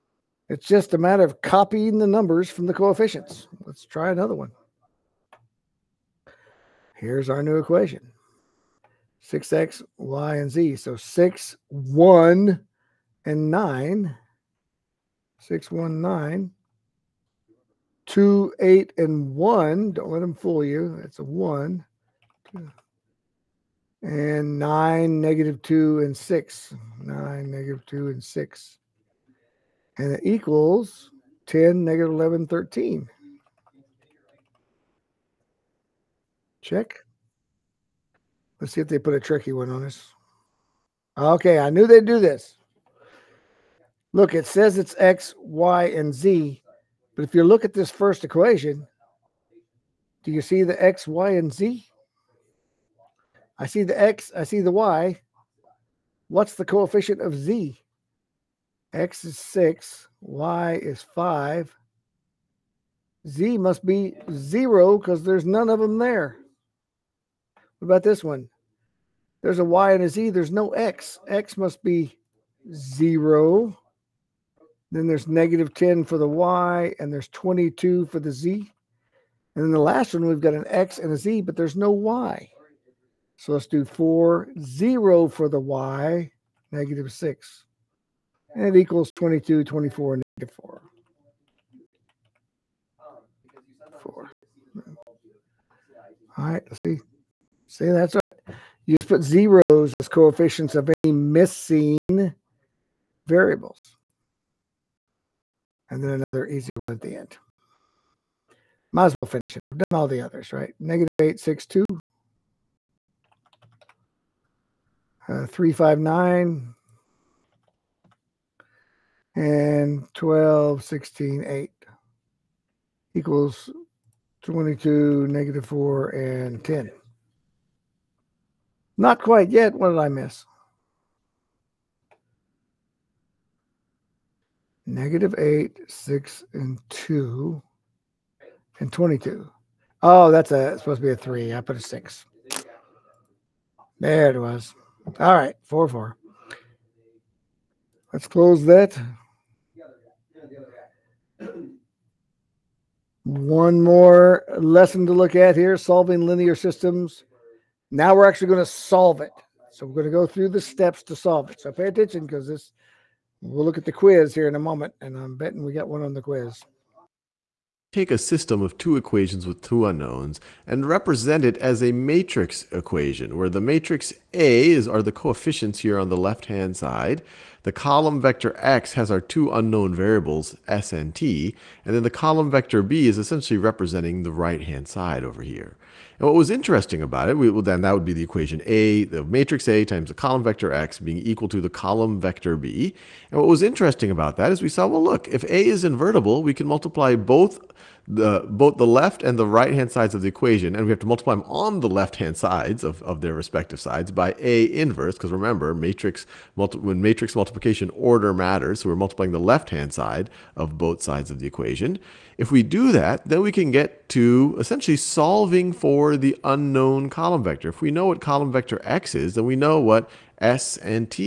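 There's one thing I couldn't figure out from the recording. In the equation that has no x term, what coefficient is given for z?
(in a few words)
22.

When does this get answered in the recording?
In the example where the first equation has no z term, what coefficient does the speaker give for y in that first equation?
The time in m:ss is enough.
1:00.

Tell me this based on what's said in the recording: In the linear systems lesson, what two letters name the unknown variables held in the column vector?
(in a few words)
s and t.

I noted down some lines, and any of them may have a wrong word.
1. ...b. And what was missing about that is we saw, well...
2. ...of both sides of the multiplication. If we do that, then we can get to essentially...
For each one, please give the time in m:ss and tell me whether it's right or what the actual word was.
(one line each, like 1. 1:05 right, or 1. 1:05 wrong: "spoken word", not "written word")
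1. 3:12 wrong: "interesting", not "missing"
2. 3:30 wrong: "equation", not "multiplication".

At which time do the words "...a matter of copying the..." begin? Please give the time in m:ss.
0:00.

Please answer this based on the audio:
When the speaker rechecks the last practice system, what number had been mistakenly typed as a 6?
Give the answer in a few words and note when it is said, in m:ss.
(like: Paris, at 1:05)
3, at 2:20.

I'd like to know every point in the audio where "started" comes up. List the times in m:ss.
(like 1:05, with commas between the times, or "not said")
not said.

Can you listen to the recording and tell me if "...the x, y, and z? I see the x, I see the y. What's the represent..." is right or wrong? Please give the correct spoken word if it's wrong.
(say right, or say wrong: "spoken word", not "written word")
wrong: "coefficient", not "represent".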